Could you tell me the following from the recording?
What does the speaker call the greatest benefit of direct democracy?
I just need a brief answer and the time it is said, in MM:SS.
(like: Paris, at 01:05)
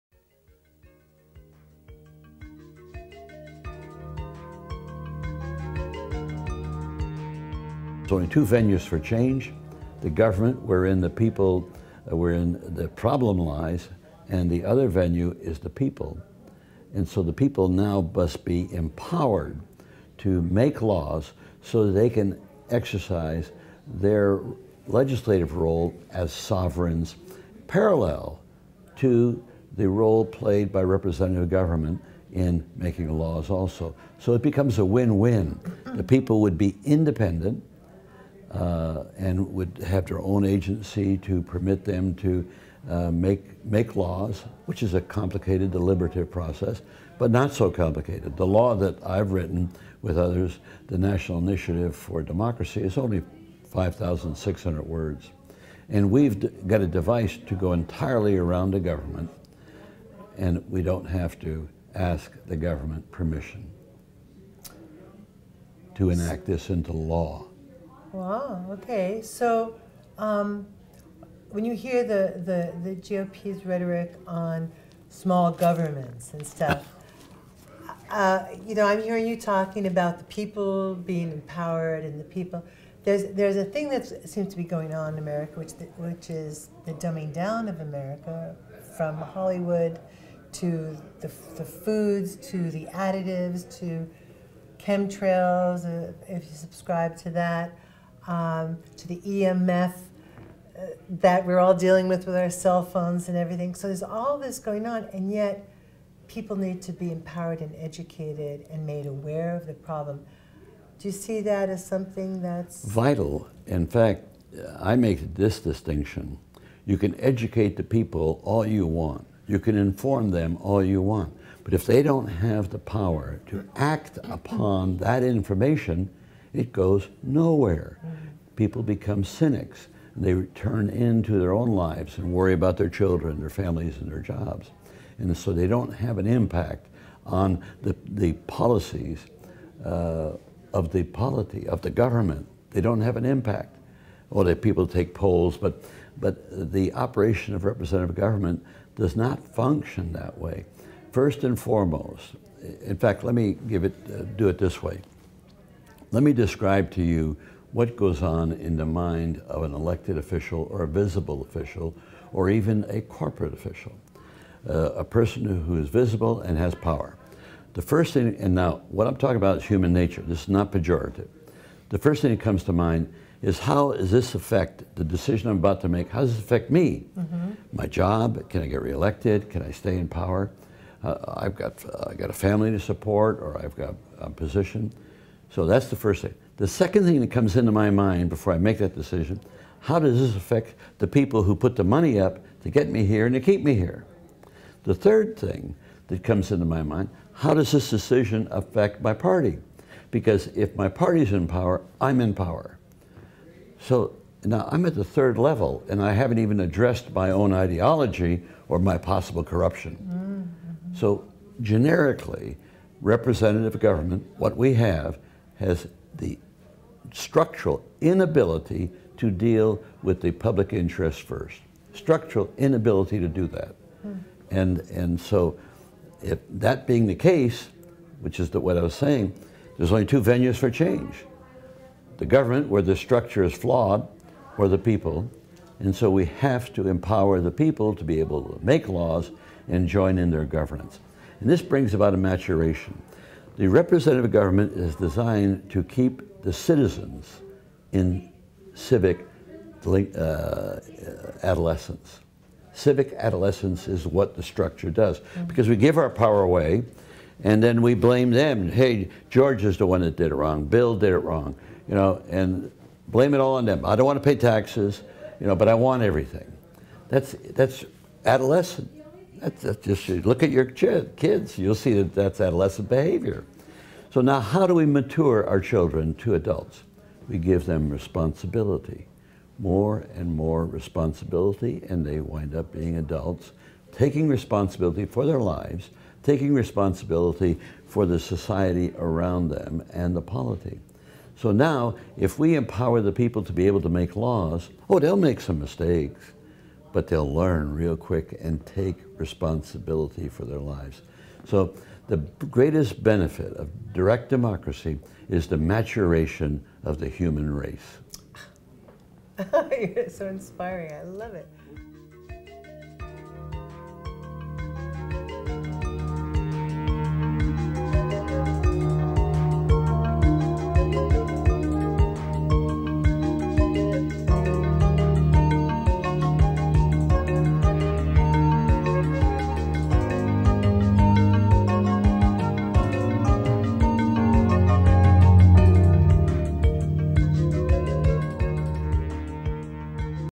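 Maturation of the human race, at 05:05.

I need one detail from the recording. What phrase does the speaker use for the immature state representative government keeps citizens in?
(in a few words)
Civic adolescence.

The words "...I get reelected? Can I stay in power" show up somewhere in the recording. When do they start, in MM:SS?
02:58.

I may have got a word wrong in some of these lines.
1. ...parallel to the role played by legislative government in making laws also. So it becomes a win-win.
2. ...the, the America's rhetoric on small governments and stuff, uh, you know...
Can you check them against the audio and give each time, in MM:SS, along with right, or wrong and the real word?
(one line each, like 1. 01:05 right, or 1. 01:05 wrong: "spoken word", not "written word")
1. 00:27 wrong: "representative", not "legislative"
2. 01:12 wrong: "GOP", not "America".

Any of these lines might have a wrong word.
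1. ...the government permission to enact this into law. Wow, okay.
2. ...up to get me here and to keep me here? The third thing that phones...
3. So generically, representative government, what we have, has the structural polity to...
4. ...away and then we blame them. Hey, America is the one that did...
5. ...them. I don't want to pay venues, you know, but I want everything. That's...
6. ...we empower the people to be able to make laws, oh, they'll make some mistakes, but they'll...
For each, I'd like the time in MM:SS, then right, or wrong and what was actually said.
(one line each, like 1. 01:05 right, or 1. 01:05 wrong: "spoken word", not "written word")
1. 01:02 right
2. 03:12 wrong: "comes", not "phones"
3. 03:30 wrong: "inability", not "polity"
4. 04:16 wrong: "George", not "America"
5. 04:23 wrong: "taxes", not "venues"
6. 04:52 right.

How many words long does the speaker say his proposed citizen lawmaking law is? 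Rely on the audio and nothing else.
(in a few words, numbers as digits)
5,600.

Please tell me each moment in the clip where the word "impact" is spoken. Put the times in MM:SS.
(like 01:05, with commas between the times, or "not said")
02:16, 02:23.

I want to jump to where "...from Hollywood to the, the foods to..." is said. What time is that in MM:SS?
01:28.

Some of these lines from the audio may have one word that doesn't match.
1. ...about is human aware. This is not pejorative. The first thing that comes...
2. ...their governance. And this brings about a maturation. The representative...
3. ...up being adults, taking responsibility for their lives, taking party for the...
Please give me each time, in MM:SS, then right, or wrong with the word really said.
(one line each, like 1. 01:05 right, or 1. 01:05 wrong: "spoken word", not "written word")
1. 02:49 wrong: "nature", not "aware"
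2. 04:00 right
3. 04:42 wrong: "responsibility", not "party".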